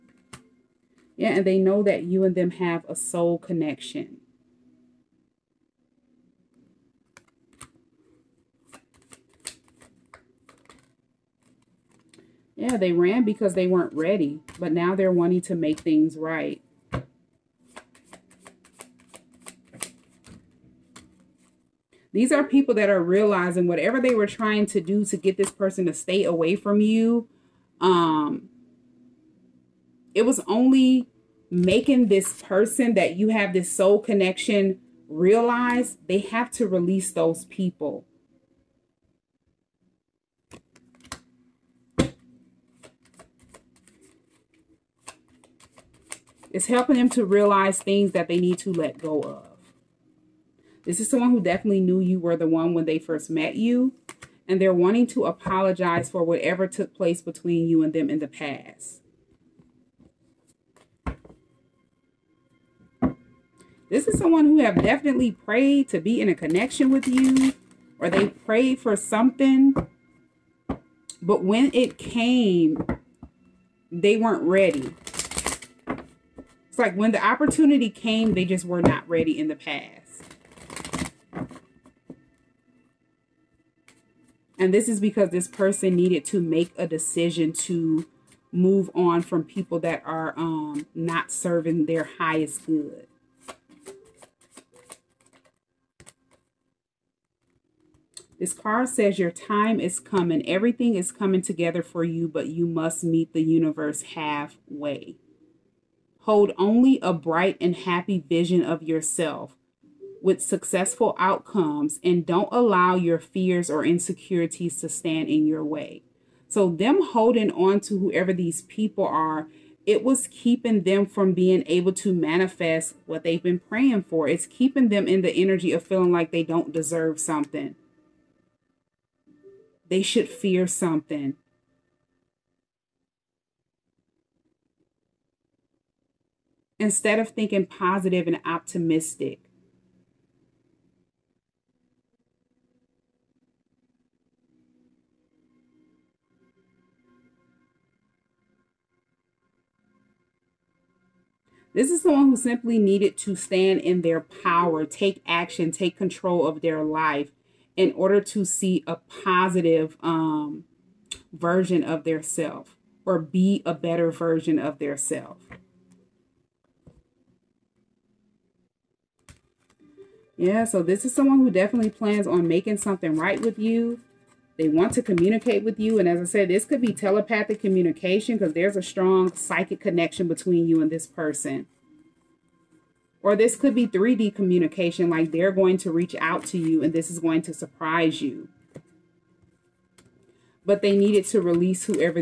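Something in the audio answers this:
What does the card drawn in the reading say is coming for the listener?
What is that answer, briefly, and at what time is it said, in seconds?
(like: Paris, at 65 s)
Your time, at 99 s.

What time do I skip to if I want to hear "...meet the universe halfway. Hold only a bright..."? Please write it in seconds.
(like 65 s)
103 s.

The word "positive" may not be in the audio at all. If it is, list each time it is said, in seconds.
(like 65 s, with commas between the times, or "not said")
137 s, 159 s.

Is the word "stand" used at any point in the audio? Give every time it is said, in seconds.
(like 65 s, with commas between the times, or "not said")
114 s, 153 s.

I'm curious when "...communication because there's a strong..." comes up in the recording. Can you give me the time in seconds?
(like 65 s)
177 s.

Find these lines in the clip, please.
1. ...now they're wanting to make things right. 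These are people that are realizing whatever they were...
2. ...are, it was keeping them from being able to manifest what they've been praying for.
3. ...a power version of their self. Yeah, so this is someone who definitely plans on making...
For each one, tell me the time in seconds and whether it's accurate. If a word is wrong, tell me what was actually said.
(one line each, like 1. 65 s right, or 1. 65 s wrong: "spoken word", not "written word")
1. 14 s right
2. 119 s right
3. 163 s wrong: "better", not "power".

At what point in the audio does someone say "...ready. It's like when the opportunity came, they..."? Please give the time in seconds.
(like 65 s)
74 s.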